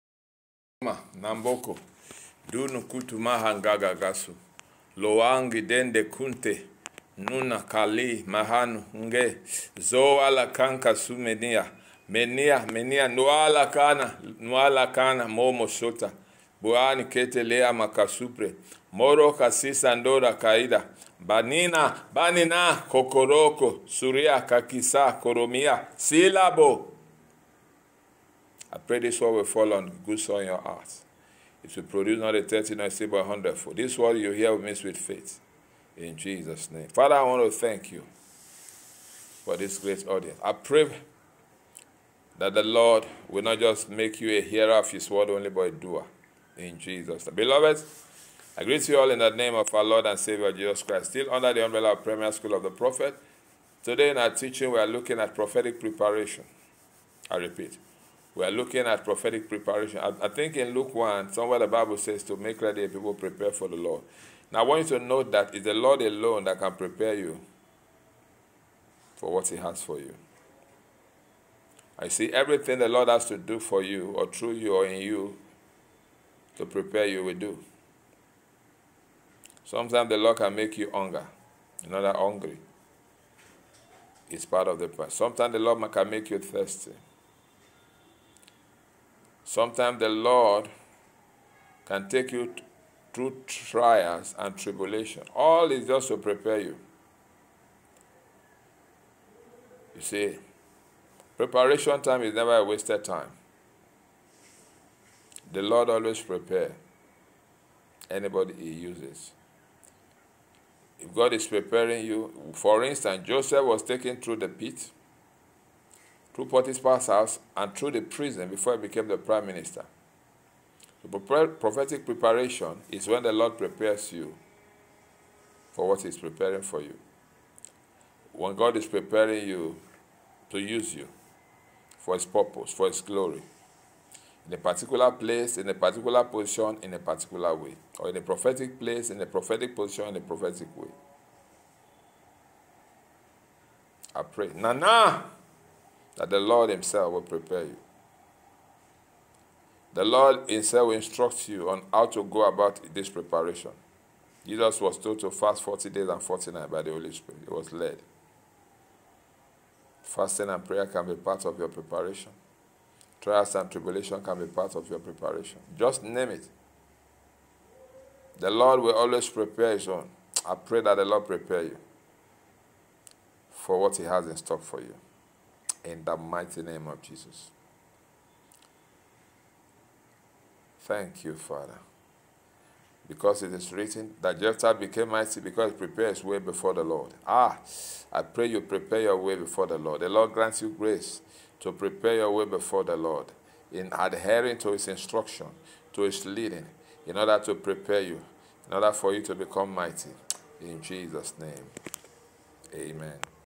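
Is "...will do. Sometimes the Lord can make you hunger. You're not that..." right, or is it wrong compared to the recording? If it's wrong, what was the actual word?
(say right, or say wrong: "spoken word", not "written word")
right.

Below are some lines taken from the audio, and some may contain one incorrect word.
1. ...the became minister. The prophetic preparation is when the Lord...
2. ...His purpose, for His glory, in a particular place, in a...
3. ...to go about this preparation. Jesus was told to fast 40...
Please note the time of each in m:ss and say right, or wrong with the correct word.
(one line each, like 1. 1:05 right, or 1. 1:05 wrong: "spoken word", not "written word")
1. 1:59 wrong: "prime", not "became"
2. 2:12 right
3. 2:32 right.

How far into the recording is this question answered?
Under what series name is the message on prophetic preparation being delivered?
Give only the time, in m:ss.
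0:52.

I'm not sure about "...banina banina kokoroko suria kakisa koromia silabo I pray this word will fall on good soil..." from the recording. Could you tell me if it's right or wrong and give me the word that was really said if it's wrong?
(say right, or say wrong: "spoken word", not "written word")
right.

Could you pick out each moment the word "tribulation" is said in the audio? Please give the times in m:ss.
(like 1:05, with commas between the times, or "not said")
1:34, 2:43.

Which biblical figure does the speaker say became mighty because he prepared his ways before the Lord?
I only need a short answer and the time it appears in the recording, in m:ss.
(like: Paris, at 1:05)
Jephthah, at 3:04.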